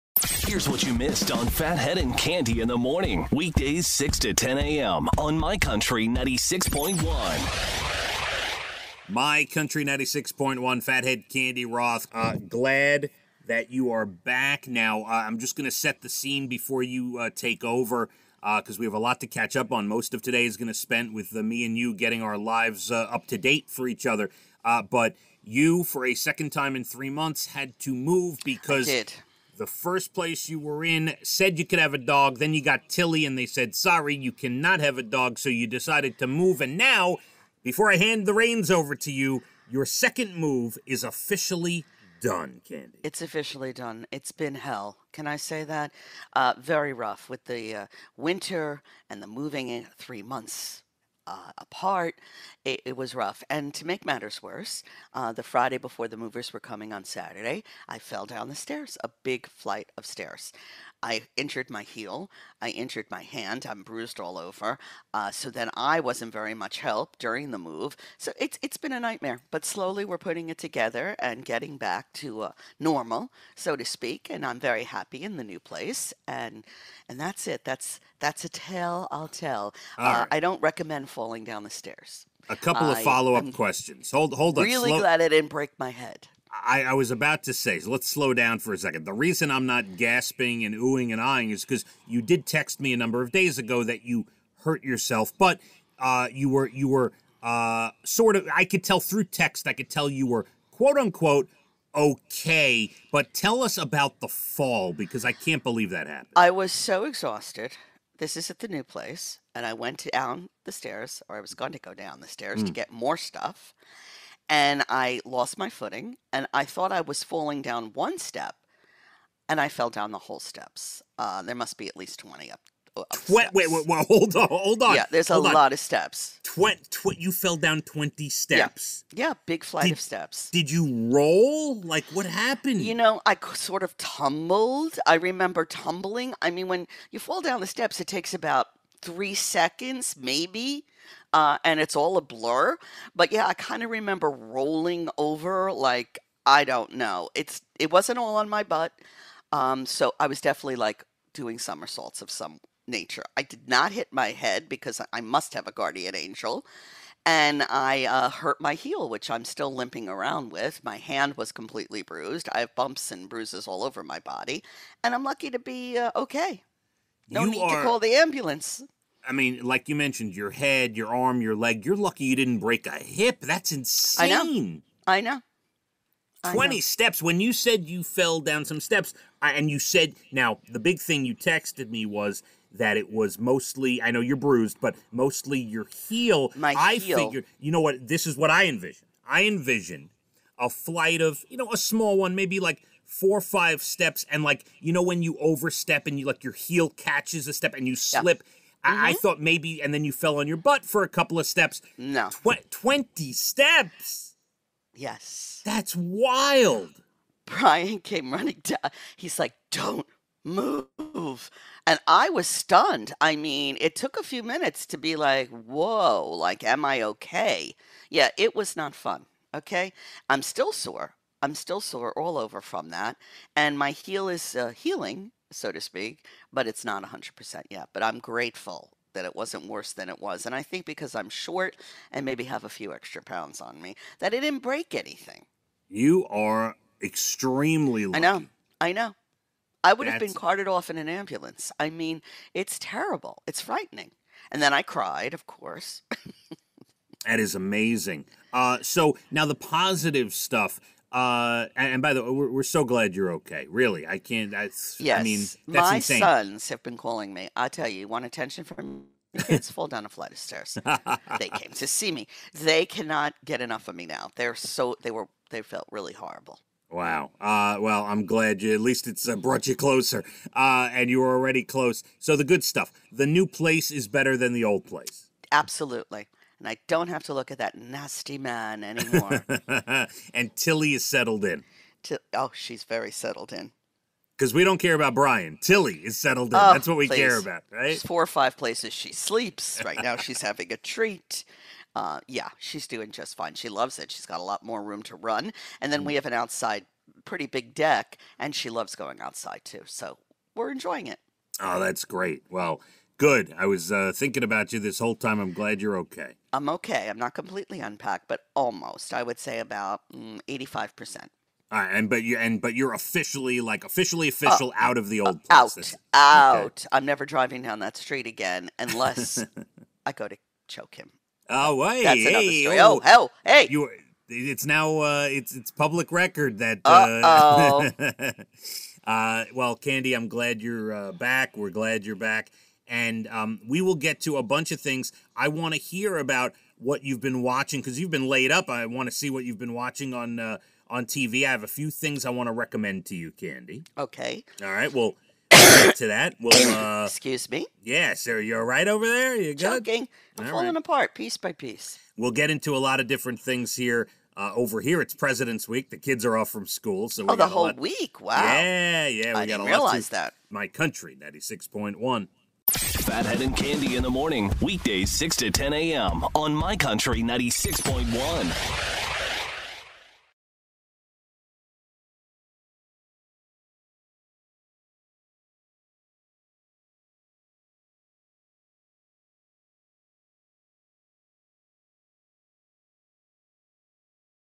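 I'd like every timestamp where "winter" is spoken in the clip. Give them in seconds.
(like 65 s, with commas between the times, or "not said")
48 s.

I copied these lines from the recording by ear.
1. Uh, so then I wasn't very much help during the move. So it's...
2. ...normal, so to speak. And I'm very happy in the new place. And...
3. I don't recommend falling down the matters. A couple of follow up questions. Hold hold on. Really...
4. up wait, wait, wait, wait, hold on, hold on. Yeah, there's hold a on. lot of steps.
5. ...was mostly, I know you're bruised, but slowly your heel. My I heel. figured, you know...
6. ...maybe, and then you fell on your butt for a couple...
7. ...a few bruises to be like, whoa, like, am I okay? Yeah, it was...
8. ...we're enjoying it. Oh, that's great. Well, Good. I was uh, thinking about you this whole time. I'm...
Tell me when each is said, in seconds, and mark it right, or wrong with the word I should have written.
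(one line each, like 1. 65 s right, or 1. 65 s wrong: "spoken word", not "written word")
1. 65 s right
2. 72 s right
3. 80 s wrong: "stairs", not "matters"
4. 122 s right
5. 183 s wrong: "mostly", not "slowly"
6. 199 s right
7. 214 s wrong: "minutes", not "bruises"
8. 300 s right.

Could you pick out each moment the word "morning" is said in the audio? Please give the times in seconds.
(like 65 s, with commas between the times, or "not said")
2 s, 364 s.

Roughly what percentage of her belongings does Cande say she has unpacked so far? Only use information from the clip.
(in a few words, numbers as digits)
85%.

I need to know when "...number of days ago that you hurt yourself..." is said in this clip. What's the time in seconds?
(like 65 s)
92 s.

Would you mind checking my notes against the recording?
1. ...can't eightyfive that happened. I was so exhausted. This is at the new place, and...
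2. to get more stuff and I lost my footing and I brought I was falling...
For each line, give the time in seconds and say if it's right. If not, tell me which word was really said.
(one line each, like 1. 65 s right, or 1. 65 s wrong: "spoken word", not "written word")
1. 105 s wrong: "believe", not "eightyfive"
2. 112 s wrong: "thought", not "brought".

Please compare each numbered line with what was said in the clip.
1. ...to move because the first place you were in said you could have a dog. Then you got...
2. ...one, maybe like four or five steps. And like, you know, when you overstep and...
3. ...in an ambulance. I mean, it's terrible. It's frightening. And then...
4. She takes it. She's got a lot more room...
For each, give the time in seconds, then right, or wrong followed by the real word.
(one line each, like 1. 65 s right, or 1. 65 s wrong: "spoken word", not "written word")
1. 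27 s right
2. 192 s right
3. 240 s right
4. 293 s wrong: "loves", not "takes".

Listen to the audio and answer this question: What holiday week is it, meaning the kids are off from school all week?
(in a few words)
President's Week.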